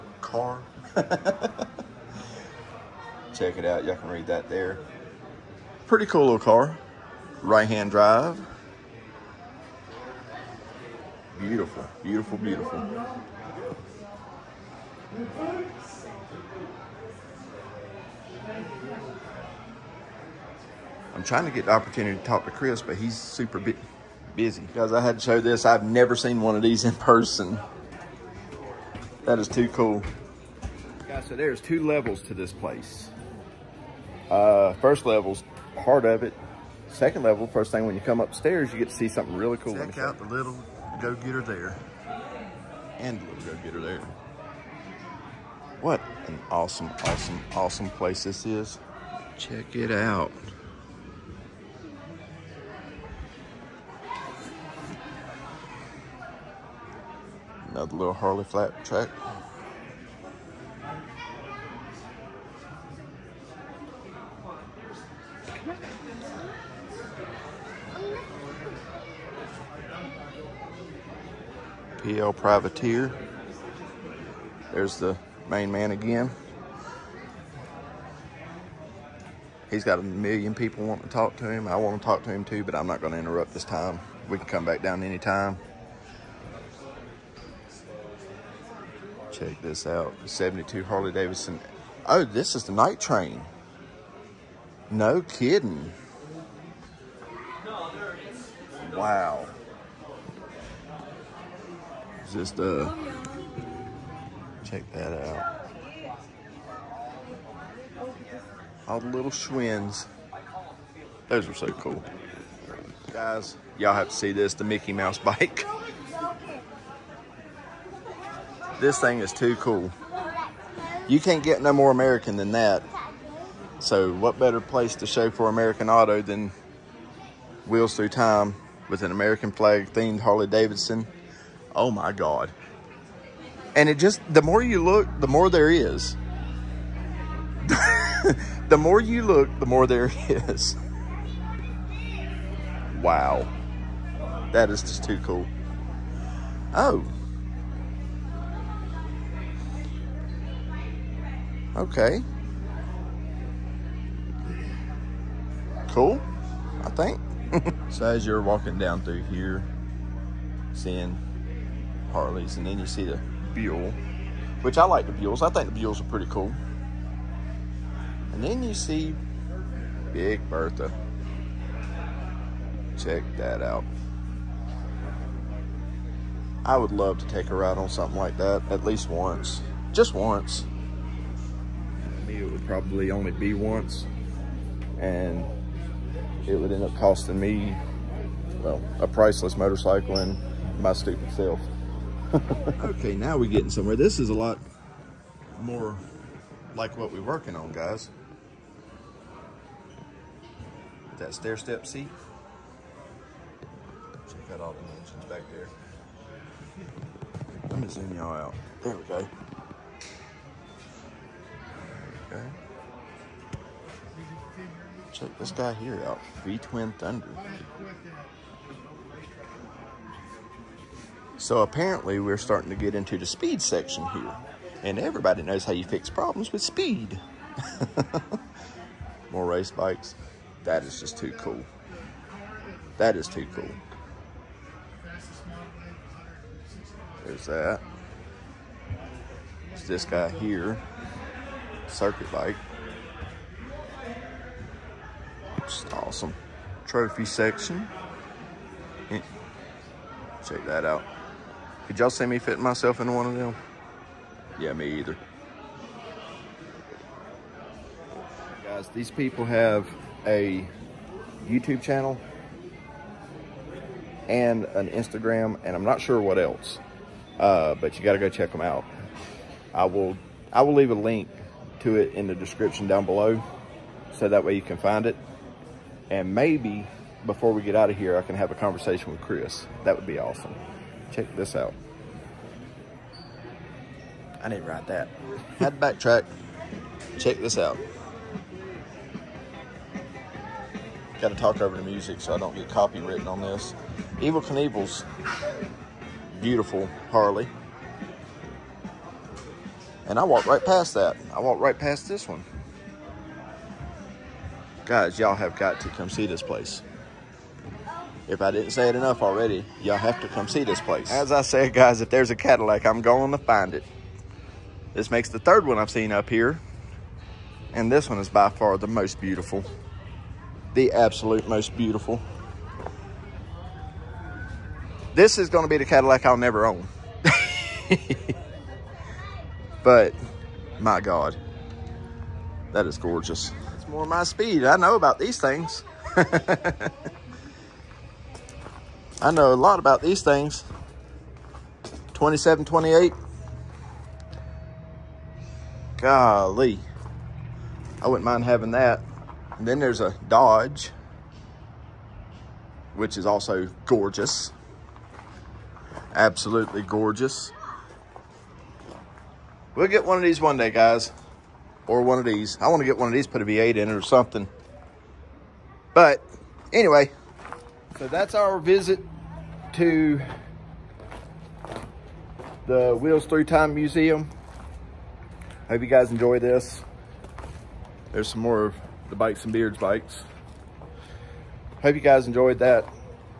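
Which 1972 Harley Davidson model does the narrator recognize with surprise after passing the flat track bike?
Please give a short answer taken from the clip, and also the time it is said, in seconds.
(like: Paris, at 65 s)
Night Train, at 92 s.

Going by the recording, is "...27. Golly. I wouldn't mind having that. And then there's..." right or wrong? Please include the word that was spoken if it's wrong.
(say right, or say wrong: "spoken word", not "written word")
wrong: "28", not "27".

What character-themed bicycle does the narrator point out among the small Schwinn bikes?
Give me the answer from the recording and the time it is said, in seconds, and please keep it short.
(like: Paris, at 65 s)
Mickey Mouse bike, at 114 s.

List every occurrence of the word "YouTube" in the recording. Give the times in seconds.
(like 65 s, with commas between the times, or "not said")
261 s.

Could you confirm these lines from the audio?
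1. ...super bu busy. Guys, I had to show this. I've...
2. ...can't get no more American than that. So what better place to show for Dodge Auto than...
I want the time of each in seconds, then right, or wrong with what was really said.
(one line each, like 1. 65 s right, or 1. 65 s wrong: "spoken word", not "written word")
1. 23 s right
2. 121 s wrong: "American", not "Dodge".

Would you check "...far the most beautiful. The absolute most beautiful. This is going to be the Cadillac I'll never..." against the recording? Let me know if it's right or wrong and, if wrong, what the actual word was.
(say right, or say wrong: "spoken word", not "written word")
right.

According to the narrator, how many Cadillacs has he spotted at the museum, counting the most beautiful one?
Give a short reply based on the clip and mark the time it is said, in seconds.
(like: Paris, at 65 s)
3, at 315 s.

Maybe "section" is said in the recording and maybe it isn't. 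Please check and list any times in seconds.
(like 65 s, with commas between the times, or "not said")
223 s, 247 s.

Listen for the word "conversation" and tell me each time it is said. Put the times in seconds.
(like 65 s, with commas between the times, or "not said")
278 s.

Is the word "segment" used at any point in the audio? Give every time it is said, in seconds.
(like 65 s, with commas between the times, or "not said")
not said.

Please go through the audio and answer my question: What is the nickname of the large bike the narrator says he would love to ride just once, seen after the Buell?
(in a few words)
Big Bertha.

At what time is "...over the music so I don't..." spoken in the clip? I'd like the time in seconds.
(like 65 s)
291 s.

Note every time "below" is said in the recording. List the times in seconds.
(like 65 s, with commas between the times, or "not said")
273 s.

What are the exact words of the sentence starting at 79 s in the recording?
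He's got a million people wanting to talk to him.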